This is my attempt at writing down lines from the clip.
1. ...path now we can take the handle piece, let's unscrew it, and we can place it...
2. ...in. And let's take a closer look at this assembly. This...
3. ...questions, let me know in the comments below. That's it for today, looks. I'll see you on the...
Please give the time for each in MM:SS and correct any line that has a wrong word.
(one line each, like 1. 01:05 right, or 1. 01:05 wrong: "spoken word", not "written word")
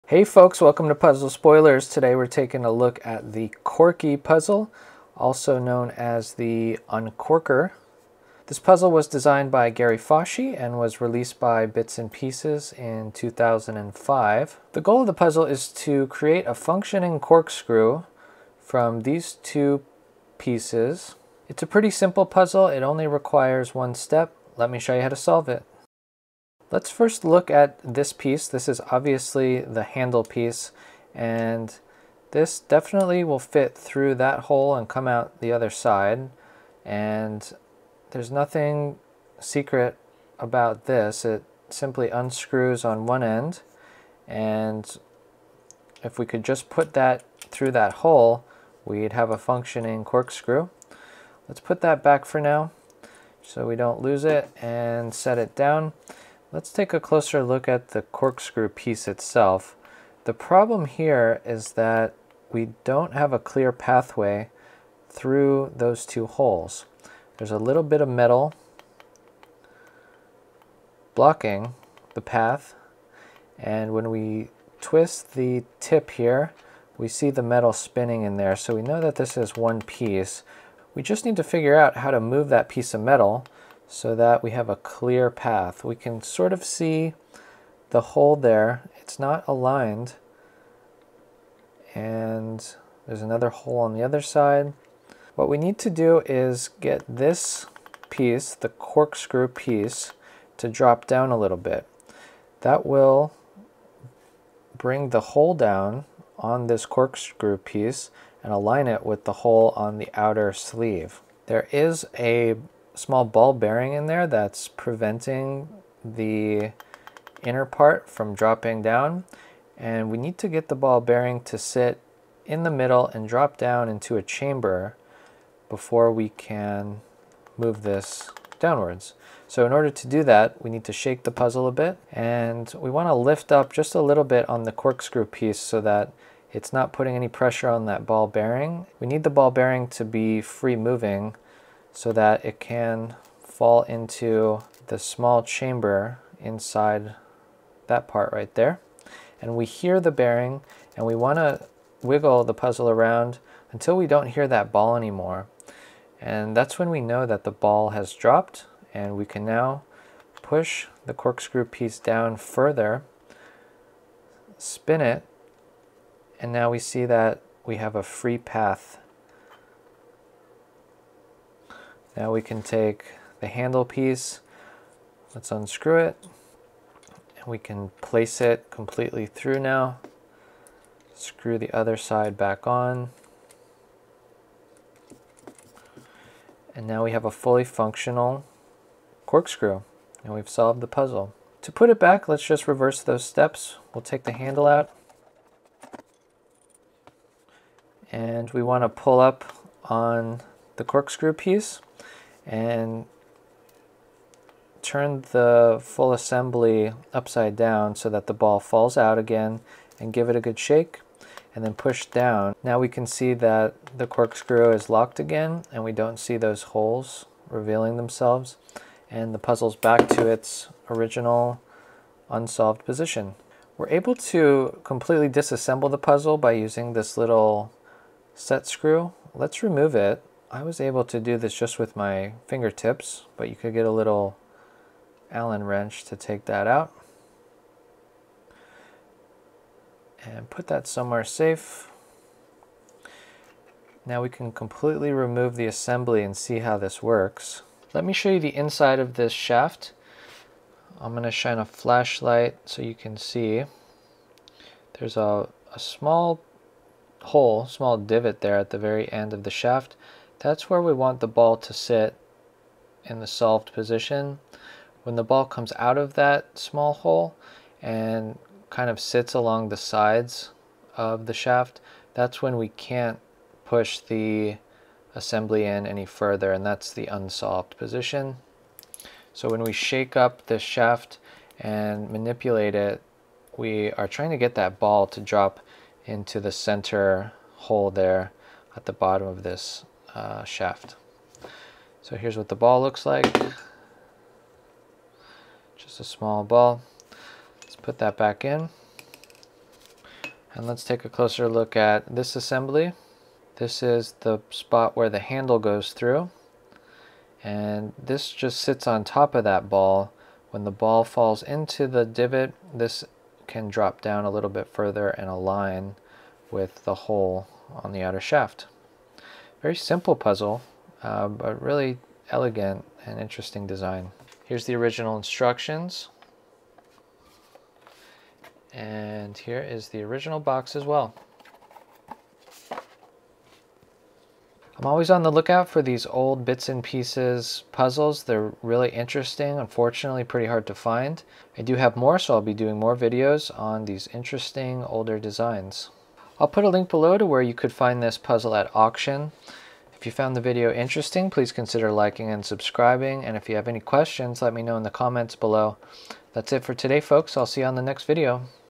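1. 02:48 right
2. 04:58 right
3. 05:53 wrong: "folks", not "looks".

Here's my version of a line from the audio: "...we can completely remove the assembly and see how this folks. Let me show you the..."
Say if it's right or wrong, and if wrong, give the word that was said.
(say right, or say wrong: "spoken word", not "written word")
wrong: "works", not "folks".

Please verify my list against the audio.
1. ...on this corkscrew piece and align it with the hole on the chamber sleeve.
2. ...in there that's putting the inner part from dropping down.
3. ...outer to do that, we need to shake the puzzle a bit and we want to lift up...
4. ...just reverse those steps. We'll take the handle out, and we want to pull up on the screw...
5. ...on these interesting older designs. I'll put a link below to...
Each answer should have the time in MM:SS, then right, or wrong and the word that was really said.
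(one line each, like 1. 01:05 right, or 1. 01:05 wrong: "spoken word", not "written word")
1. 01:46 wrong: "outer", not "chamber"
2. 01:53 wrong: "preventing", not "putting"
3. 02:09 wrong: "order", not "outer"
4. 03:12 wrong: "corkscrew", not "screw"
5. 05:43 right.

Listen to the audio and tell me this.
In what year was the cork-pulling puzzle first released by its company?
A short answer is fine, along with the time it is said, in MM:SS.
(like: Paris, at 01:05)
2005, at 00:13.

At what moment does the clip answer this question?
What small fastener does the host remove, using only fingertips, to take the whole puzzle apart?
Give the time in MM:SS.
03:48.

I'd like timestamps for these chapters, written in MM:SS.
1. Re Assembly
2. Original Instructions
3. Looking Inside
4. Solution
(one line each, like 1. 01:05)
1. 03:11
2. 05:24
3. 03:44
4. 00:26.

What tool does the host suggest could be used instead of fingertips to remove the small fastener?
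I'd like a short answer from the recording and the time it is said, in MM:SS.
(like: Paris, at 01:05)
Allen wrench, at 03:55.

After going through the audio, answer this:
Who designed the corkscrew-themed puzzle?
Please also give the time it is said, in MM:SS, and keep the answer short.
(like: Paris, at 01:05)
Gary Foshee, at 00:09.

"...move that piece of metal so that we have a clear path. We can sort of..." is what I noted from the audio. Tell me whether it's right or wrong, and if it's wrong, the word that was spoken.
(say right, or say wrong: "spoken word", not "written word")
right.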